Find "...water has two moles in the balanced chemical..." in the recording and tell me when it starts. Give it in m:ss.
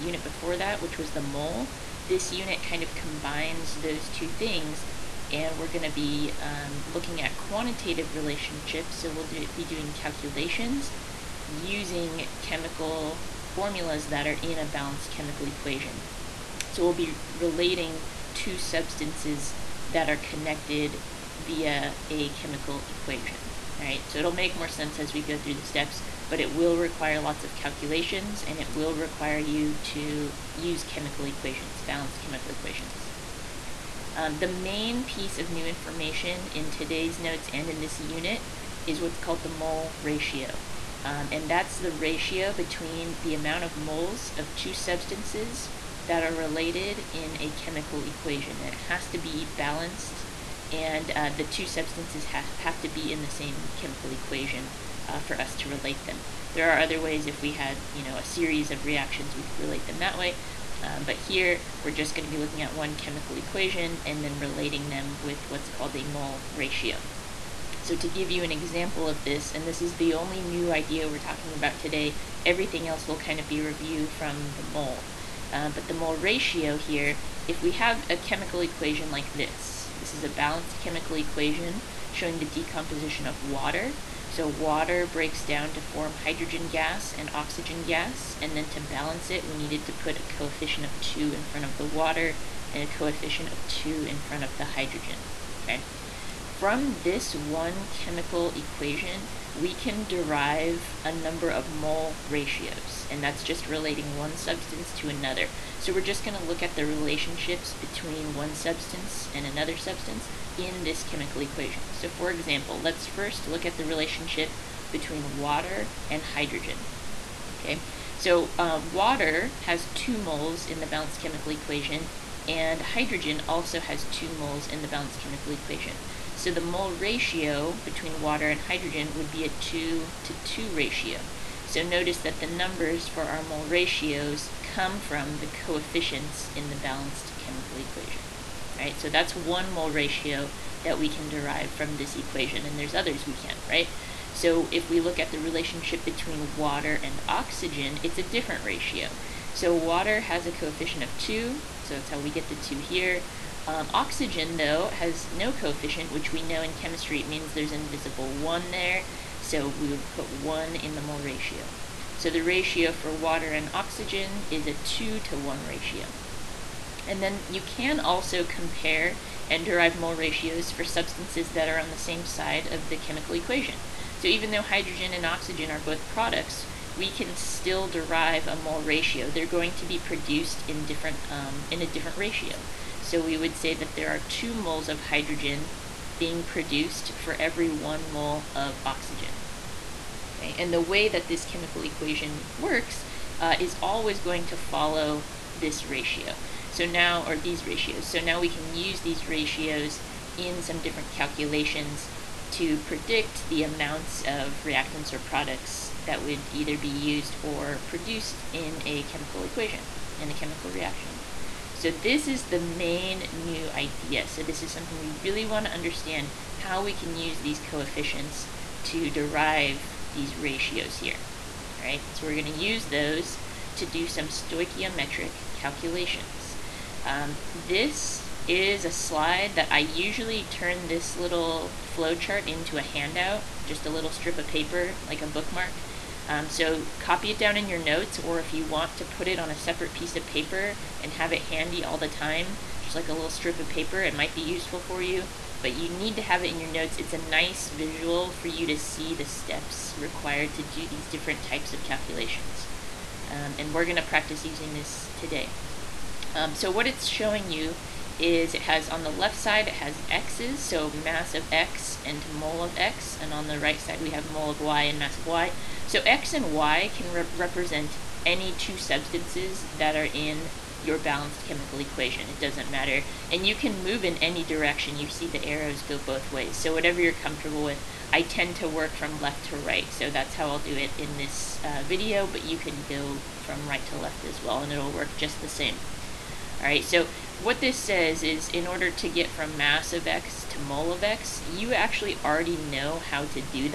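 1:58.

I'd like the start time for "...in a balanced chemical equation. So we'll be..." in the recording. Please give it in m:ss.
0:14.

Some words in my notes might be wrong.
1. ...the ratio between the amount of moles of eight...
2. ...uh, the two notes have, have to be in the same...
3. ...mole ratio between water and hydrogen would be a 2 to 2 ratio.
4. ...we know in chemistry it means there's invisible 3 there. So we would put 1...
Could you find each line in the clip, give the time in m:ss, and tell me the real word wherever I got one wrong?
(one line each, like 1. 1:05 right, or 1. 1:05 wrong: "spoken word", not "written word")
1. 0:41 wrong: "two", not "eight"
2. 0:51 wrong: "substances", not "notes"
3. 2:06 right
4. 2:36 wrong: "1", not "3".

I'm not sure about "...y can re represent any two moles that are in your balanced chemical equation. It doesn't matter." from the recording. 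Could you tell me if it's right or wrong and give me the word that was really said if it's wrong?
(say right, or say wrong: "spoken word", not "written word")
wrong: "substances", not "moles".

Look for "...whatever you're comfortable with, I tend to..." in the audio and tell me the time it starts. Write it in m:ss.
4:36.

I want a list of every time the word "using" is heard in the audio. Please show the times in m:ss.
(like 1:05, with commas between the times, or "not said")
0:11, 4:14.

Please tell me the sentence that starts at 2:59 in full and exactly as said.
They're going to be produced in different um, in a different ratio.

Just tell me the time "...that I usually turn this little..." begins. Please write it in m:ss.
3:49.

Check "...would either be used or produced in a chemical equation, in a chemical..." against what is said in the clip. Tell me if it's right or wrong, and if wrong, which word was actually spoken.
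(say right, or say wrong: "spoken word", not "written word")
right.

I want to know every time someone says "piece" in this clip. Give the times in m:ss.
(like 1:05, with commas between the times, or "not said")
0:35, 3:59.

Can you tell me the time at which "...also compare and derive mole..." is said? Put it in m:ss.
2:47.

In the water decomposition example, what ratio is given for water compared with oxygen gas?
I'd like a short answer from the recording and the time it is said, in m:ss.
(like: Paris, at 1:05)
2 to 1, at 2:44.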